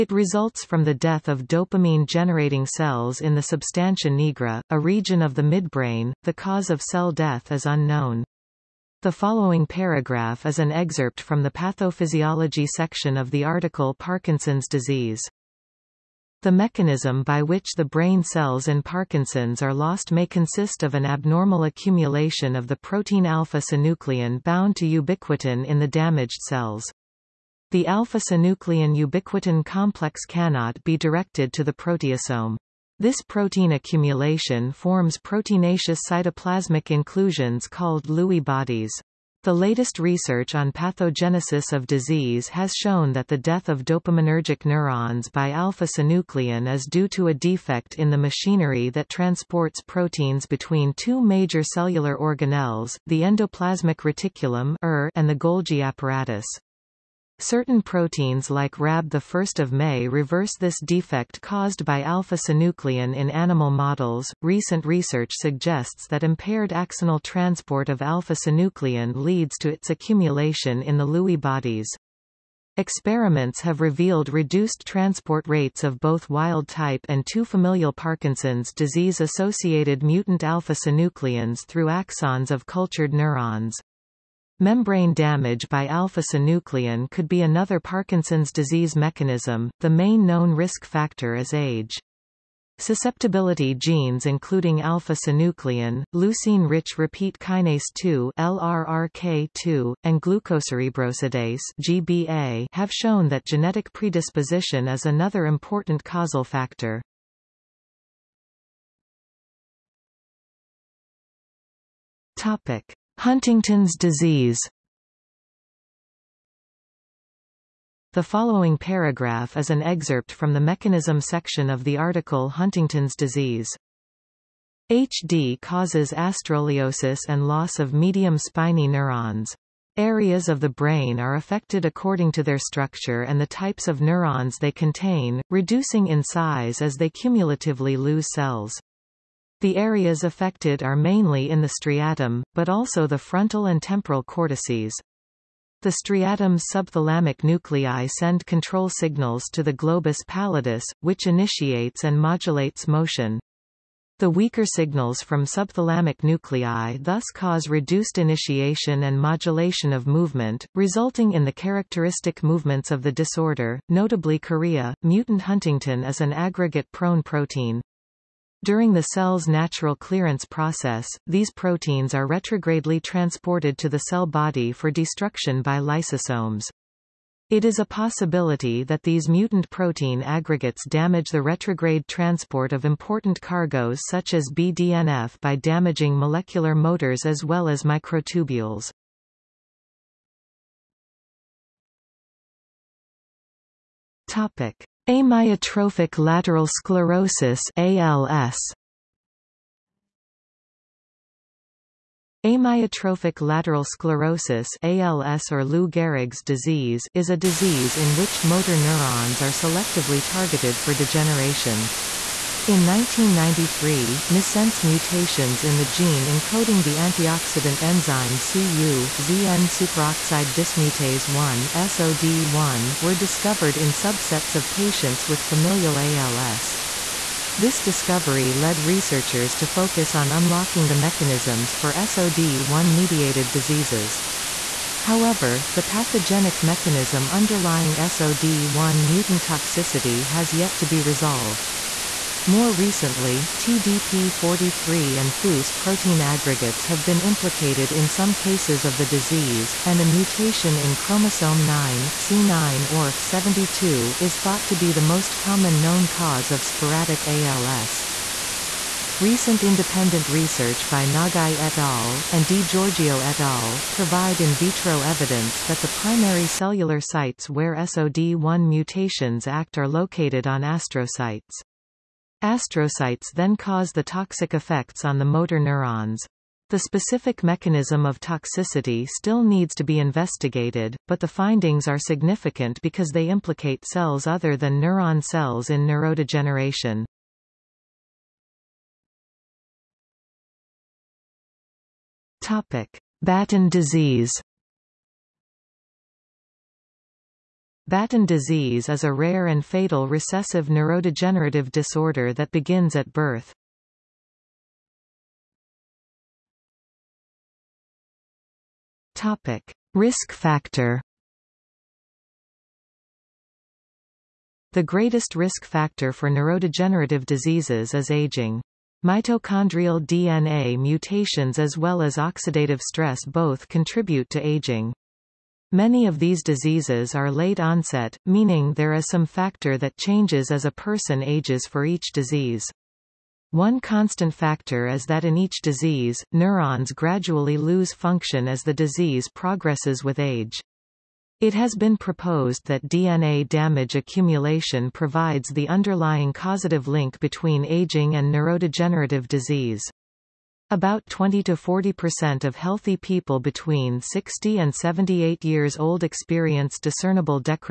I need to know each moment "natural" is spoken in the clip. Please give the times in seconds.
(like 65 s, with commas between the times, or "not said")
169 s.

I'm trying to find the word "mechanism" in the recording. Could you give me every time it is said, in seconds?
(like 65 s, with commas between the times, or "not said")
16 s, 88 s, 120 s, 230 s, 236 s, 277 s.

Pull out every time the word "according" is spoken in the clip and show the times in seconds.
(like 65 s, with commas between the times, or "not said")
131 s.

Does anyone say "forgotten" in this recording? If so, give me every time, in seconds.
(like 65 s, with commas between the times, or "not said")
not said.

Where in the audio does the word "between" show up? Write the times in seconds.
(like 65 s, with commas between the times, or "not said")
50 s, 347 s, 353 s.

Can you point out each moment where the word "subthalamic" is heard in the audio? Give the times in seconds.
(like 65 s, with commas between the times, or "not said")
146 s, 155 s.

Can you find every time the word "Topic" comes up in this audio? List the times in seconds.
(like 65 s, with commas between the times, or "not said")
112 s, 194 s, 292 s, 309 s.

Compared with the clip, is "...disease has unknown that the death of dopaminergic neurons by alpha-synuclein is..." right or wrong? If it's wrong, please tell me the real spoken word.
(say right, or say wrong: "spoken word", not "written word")
wrong: "shown", not "unknown".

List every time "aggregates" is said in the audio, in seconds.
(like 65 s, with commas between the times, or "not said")
166 s, 180 s, 246 s.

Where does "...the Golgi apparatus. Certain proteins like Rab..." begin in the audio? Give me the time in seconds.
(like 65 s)
55 s.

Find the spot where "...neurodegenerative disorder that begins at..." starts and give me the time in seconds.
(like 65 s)
300 s.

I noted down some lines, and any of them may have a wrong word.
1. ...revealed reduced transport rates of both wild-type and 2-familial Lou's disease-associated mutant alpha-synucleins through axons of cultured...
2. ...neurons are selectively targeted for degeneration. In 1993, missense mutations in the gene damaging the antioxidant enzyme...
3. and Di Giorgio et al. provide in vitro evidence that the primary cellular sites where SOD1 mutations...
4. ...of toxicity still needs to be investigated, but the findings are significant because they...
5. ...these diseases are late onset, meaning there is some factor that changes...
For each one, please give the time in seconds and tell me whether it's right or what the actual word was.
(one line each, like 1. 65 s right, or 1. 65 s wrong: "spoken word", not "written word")
1. 73 s wrong: "Parkinson", not "Lou"
2. 208 s wrong: "encoding", not "damaging"
3. 262 s right
4. 278 s right
5. 326 s right.